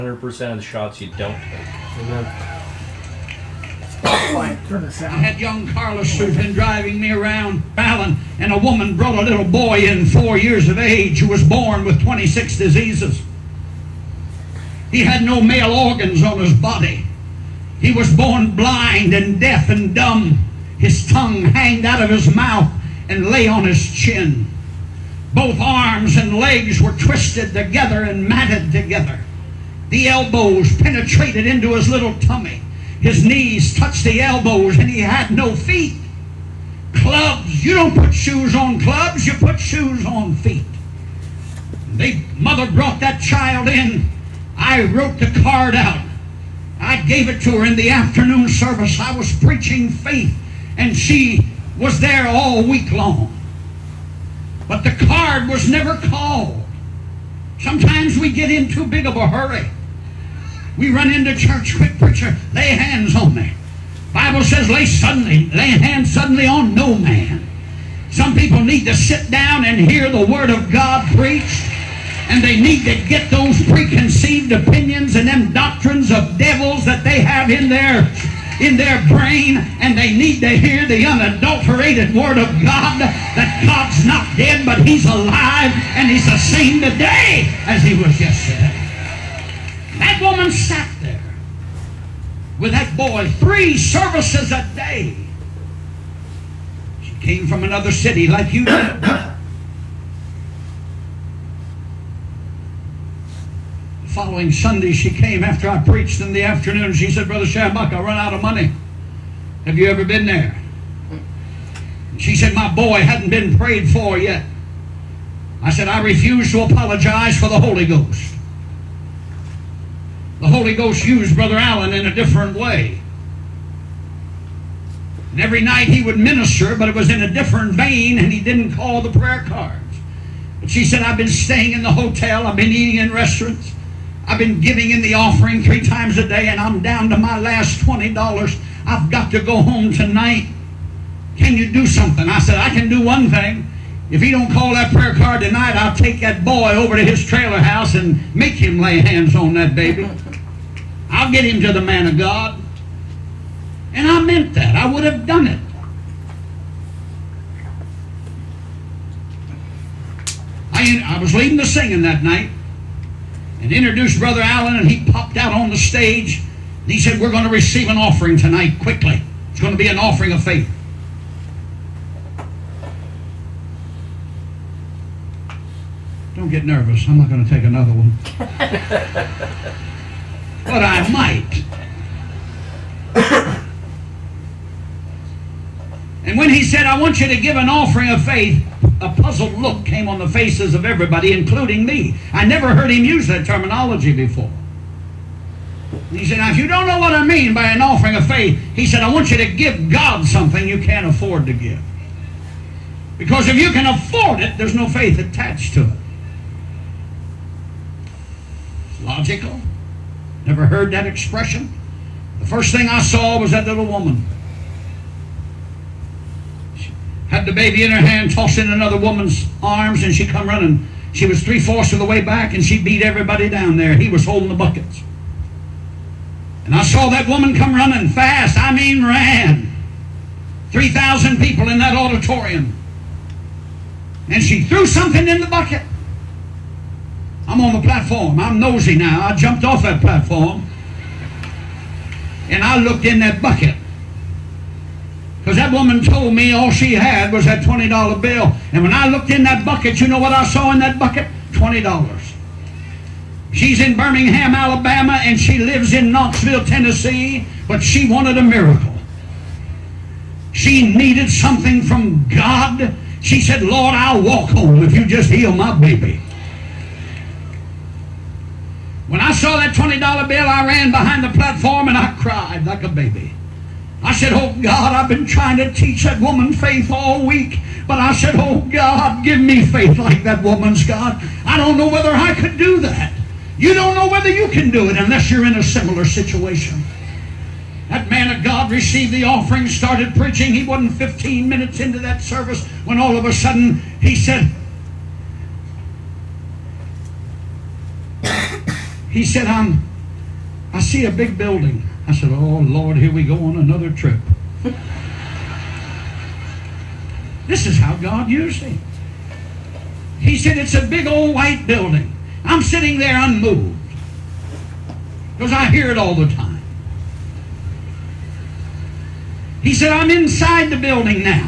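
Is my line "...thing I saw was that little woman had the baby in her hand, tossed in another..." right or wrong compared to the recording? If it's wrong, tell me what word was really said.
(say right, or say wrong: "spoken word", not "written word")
right.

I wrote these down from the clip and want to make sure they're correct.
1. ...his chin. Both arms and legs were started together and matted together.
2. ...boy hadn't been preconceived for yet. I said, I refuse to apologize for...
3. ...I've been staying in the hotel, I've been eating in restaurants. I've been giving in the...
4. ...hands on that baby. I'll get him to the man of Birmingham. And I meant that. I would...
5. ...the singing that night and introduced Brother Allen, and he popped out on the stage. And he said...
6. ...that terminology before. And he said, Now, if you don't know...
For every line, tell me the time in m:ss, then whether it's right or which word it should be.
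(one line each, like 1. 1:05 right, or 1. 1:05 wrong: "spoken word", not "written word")
1. 0:23 wrong: "twisted", not "started"
2. 1:52 wrong: "prayed", not "preconceived"
3. 2:11 right
4. 2:29 wrong: "God", not "Birmingham"
5. 2:41 right
6. 3:13 right.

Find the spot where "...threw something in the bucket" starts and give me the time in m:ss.
3:54.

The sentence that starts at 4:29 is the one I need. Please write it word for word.
When I saw that $20 bill, I ran behind the platform and I cried like a baby.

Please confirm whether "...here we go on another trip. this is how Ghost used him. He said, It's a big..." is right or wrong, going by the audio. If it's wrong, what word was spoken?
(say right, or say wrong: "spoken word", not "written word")
wrong: "God", not "Ghost".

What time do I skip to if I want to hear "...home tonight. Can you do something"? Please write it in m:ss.
2:19.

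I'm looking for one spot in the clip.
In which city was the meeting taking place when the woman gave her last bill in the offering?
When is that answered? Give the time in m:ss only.
4:13.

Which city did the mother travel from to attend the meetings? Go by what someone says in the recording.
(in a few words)
Knoxville.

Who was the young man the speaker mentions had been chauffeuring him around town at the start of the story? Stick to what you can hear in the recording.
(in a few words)
Carlos.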